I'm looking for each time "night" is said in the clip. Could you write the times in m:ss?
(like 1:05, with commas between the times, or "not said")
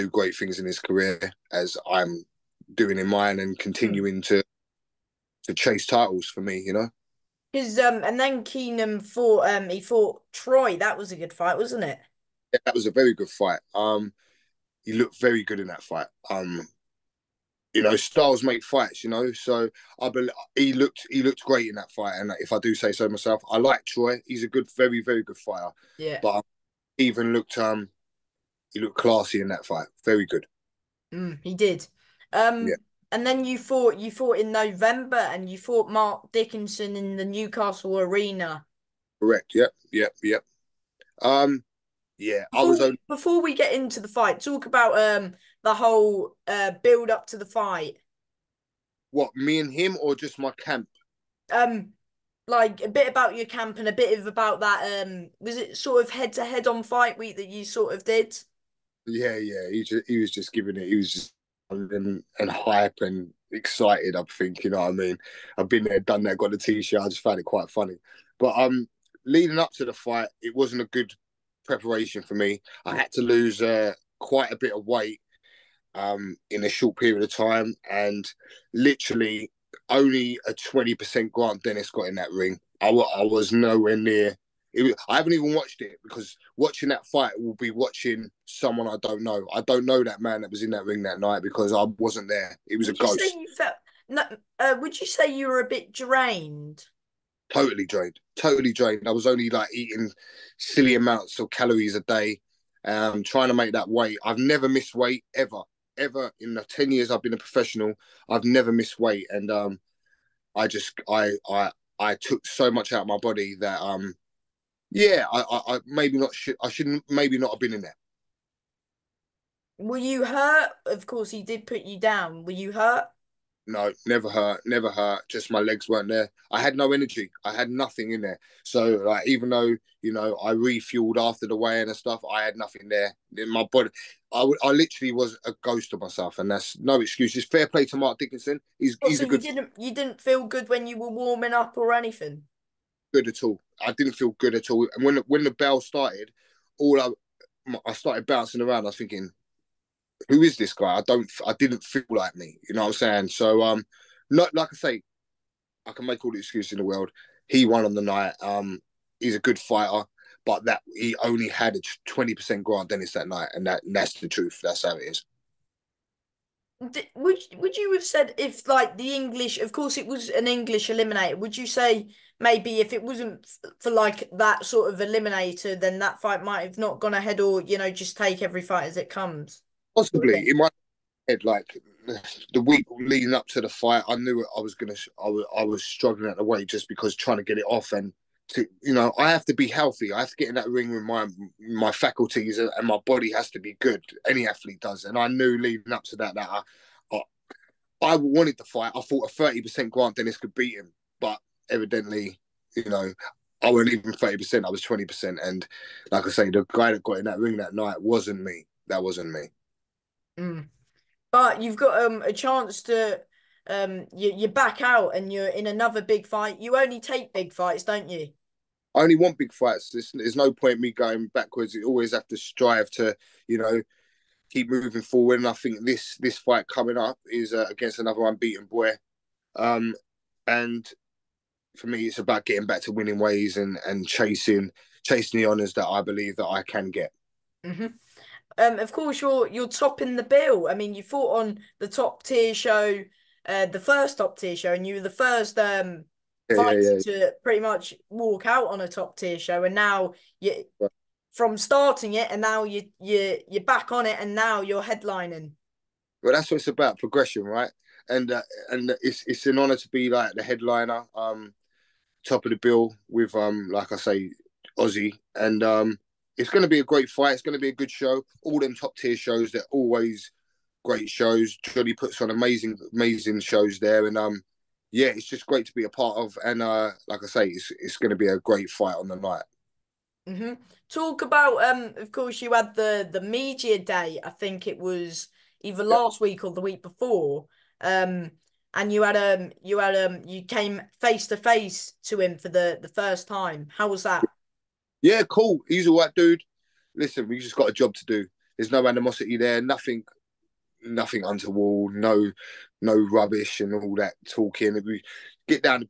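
1:31, 2:38, 2:43, 3:27, 4:39.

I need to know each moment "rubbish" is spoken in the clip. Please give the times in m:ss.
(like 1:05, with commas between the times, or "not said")
5:02.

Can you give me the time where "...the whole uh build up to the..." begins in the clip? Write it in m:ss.
0:45.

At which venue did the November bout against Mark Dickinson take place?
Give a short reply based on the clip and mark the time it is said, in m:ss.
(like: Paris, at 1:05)
Newcastle Arena, at 0:37.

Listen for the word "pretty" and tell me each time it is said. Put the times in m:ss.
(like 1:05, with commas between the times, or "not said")
4:07.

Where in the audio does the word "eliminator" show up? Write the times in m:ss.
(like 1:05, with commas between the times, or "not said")
2:50, 2:54.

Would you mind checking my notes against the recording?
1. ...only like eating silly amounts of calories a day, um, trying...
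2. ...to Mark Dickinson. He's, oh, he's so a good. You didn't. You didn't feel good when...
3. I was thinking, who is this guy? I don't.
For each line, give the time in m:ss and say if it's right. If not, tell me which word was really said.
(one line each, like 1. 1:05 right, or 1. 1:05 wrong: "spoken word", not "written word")
1. 1:39 right
2. 2:17 right
3. 2:28 right.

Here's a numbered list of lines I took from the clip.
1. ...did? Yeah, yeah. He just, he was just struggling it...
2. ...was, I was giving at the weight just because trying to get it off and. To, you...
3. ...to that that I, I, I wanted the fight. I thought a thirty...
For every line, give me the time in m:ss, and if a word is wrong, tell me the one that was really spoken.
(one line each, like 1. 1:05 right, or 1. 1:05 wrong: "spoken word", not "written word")
1. 0:58 wrong: "giving", not "struggling"
2. 3:05 wrong: "struggling", not "giving"
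3. 3:16 right.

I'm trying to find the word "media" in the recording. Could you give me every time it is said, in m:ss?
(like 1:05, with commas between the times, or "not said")
4:43.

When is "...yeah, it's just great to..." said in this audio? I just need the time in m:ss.
4:34.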